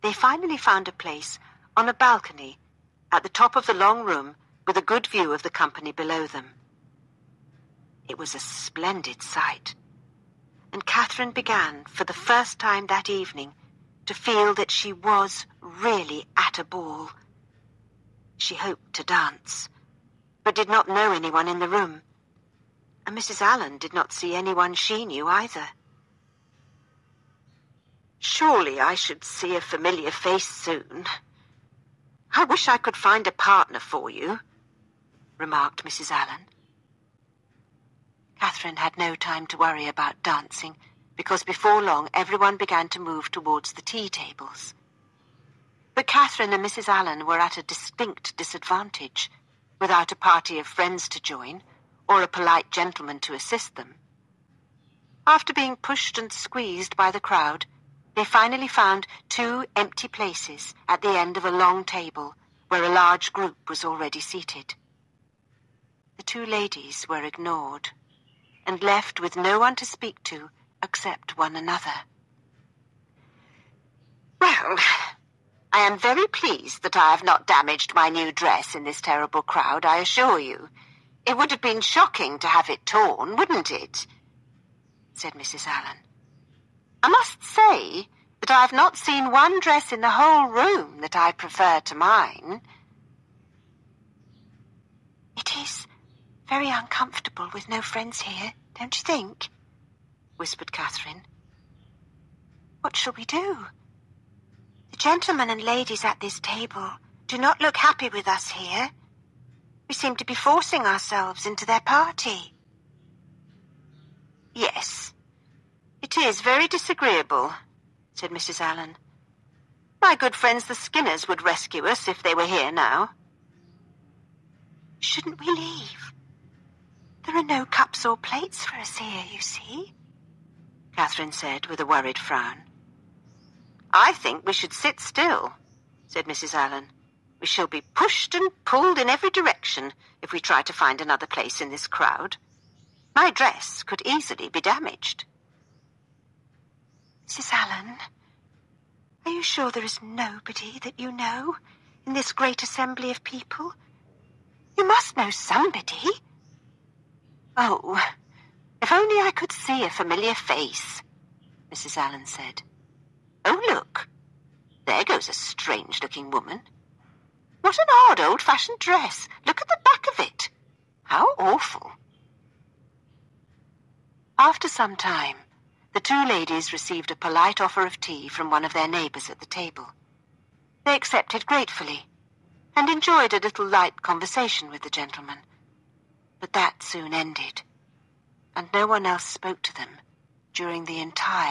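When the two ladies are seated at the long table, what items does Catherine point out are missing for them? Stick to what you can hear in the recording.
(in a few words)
Cups or plates.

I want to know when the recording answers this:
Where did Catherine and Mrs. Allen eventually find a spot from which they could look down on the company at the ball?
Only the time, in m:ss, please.
0:01.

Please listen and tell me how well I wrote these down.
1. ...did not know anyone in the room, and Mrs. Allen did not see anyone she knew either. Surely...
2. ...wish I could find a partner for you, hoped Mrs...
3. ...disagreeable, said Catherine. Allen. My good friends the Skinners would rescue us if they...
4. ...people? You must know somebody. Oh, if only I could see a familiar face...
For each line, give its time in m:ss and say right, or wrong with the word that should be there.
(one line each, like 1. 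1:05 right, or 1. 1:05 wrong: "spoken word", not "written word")
1. 0:20 right
2. 0:32 wrong: "remarked", not "hoped"
3. 1:56 wrong: "Mrs", not "Catherine"
4. 2:33 right.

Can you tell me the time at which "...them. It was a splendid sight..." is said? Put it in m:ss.
0:06.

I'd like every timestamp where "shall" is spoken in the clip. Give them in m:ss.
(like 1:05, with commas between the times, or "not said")
1:42, 2:17.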